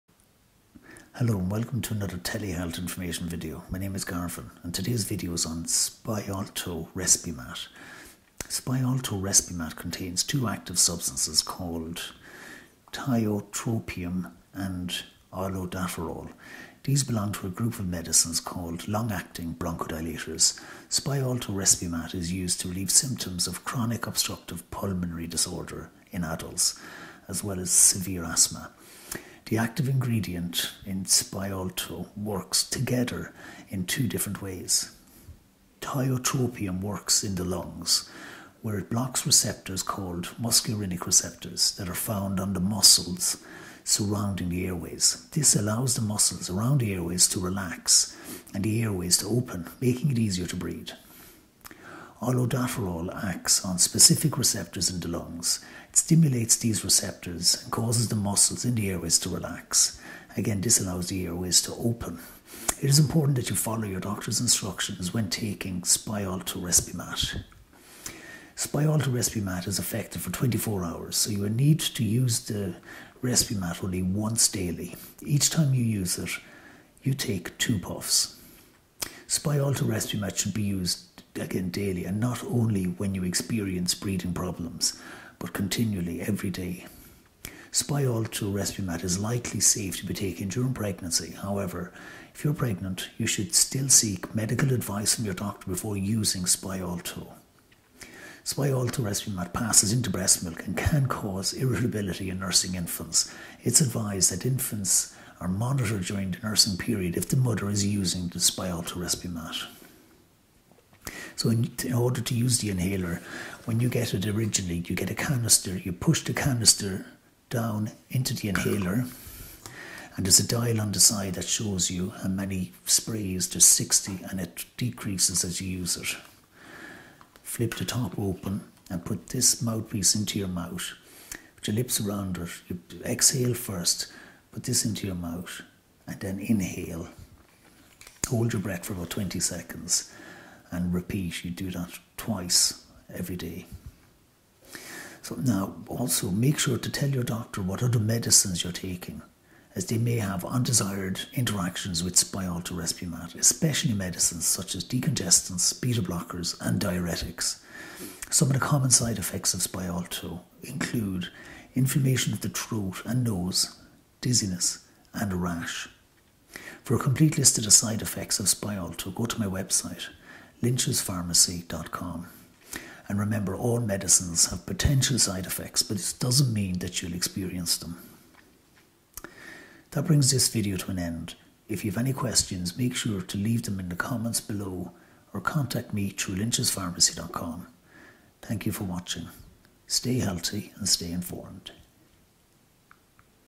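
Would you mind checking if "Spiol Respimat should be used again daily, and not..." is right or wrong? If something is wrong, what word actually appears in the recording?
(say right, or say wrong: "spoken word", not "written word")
right.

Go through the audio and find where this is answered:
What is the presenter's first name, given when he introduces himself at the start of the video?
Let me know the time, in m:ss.
0:04.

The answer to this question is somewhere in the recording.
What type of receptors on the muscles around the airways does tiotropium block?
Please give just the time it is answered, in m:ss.
0:40.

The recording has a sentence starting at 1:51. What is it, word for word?
So in, in, order to use the inhaler, when you get it originally, you get a canister.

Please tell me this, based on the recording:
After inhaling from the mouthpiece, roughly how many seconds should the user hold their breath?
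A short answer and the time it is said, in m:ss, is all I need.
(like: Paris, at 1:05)
20, at 2:19.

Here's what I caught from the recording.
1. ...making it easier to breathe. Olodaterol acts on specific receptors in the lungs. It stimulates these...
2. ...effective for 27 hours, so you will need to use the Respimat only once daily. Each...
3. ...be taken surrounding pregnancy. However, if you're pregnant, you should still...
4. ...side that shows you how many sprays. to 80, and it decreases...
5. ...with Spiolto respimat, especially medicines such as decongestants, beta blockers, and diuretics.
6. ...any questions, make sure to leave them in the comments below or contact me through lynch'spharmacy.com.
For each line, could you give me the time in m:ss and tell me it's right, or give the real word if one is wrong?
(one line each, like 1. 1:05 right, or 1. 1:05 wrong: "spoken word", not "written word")
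1. 0:49 right
2. 1:09 wrong: "24", not "27"
3. 1:30 wrong: "during", not "surrounding"
4. 2:00 wrong: "60", not "80"
5. 2:32 right
6. 3:01 right.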